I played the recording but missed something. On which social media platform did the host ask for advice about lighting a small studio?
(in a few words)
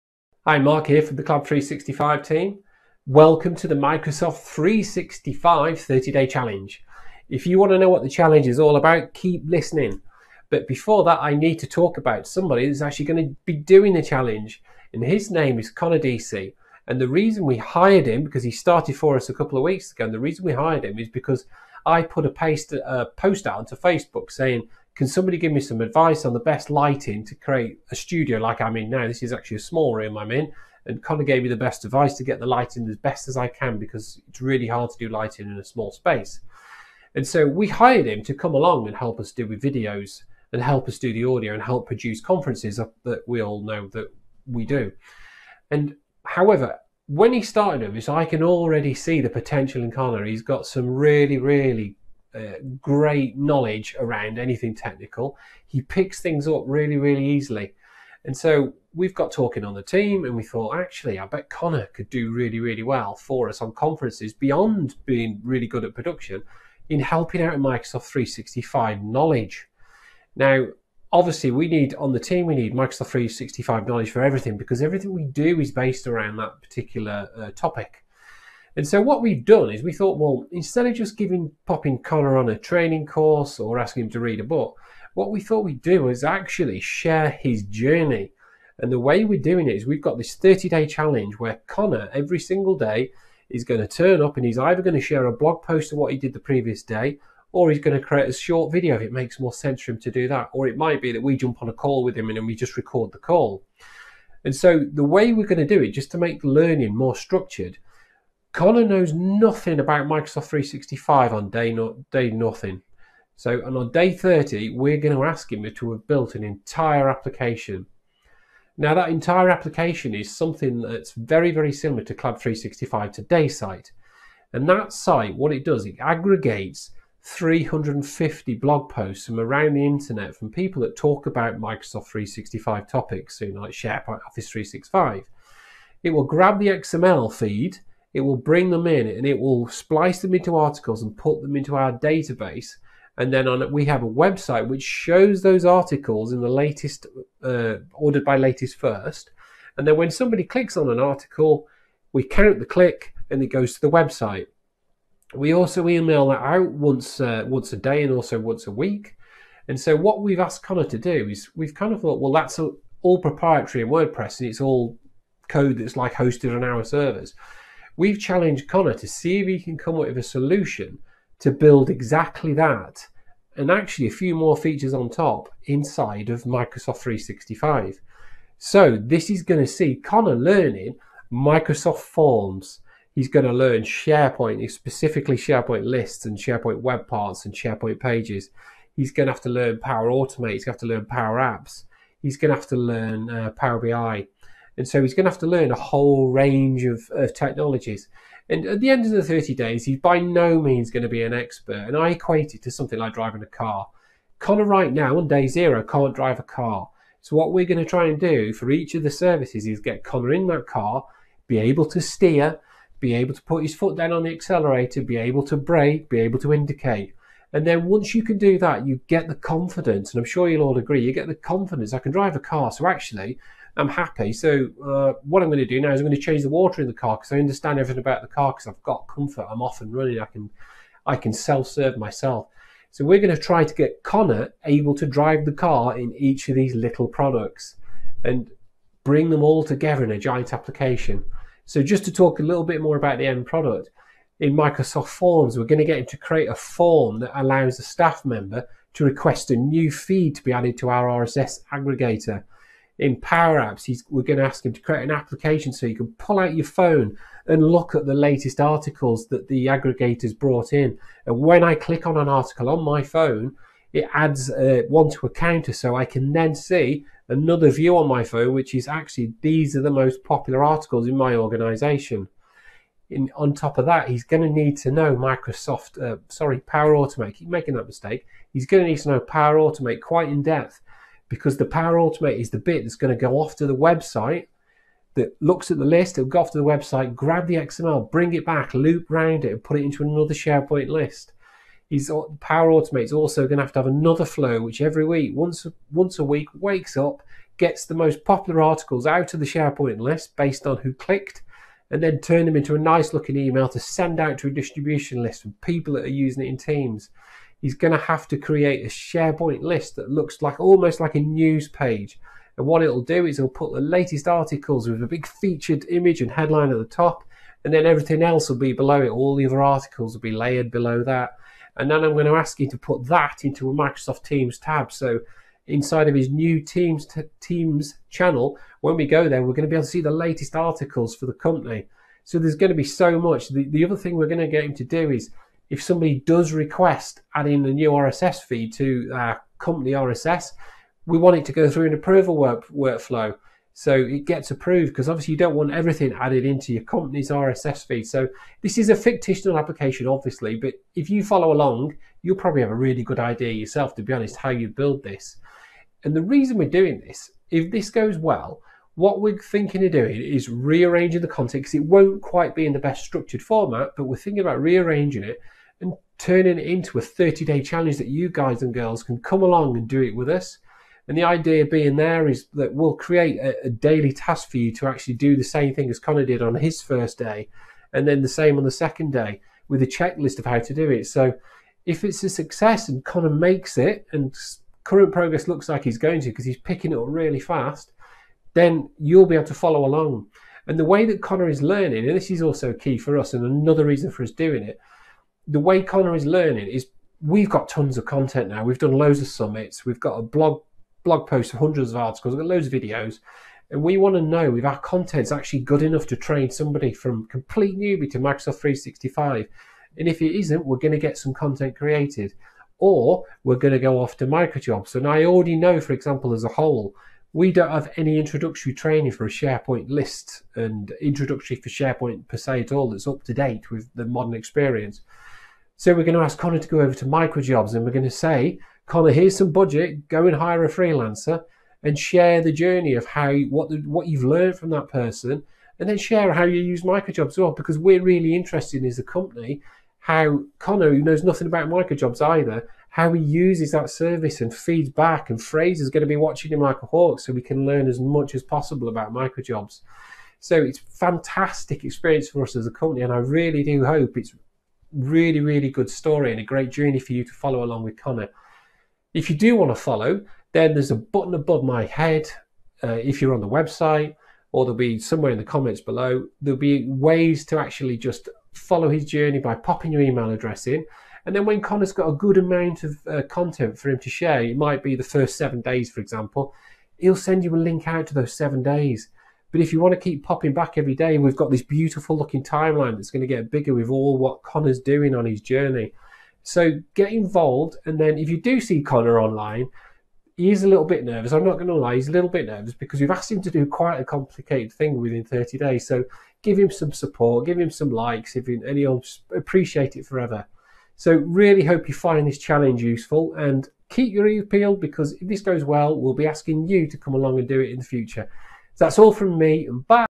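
Facebook.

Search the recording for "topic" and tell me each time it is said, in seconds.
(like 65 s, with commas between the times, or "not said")
77 s, 132 s.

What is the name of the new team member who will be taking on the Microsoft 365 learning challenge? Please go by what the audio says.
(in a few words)
Connor Deasey.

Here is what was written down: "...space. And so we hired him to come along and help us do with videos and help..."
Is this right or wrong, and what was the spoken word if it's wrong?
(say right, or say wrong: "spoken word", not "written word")
right.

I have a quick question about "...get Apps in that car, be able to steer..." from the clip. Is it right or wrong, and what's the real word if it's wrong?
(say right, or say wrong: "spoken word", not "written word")
wrong: "Connor", not "Apps".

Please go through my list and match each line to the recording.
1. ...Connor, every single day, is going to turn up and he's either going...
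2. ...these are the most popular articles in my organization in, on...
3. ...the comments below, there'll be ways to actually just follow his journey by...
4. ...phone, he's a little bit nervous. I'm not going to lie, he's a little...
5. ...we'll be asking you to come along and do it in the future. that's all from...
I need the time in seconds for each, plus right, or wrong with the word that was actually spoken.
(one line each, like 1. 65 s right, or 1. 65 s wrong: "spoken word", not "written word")
1. 91 s right
2. 269 s right
3. 465 s right
4. 489 s wrong: "online", not "phone"
5. 505 s right.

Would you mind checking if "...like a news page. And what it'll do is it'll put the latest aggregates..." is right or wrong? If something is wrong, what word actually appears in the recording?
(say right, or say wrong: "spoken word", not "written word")
wrong: "articles", not "aggregates".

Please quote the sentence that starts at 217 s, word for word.
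And then once you can do that, you get the confidence, and I'm sure you'll all agree, you get the confidence.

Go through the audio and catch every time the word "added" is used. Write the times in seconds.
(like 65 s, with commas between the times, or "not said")
250 s, 346 s.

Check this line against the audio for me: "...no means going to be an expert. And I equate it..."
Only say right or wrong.
right.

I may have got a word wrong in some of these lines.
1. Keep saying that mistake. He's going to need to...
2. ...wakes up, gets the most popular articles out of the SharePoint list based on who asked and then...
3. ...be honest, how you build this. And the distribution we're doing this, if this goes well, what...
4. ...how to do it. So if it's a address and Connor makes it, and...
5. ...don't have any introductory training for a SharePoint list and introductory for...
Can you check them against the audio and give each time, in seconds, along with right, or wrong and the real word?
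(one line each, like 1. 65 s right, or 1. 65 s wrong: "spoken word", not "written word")
1. 277 s wrong: "making", not "saying"
2. 296 s wrong: "clicked", not "asked"
3. 354 s wrong: "reason", not "distribution"
4. 380 s wrong: "success", not "address"
5. 417 s right.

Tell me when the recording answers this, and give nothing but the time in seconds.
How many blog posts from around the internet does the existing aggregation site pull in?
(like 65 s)
127 s.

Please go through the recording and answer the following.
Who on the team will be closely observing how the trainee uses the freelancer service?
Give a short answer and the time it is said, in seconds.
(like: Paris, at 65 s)
Fraser, at 445 s.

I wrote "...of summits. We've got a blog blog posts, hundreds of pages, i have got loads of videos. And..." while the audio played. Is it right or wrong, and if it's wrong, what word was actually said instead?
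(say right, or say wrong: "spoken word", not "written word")
wrong: "articles", not "pages".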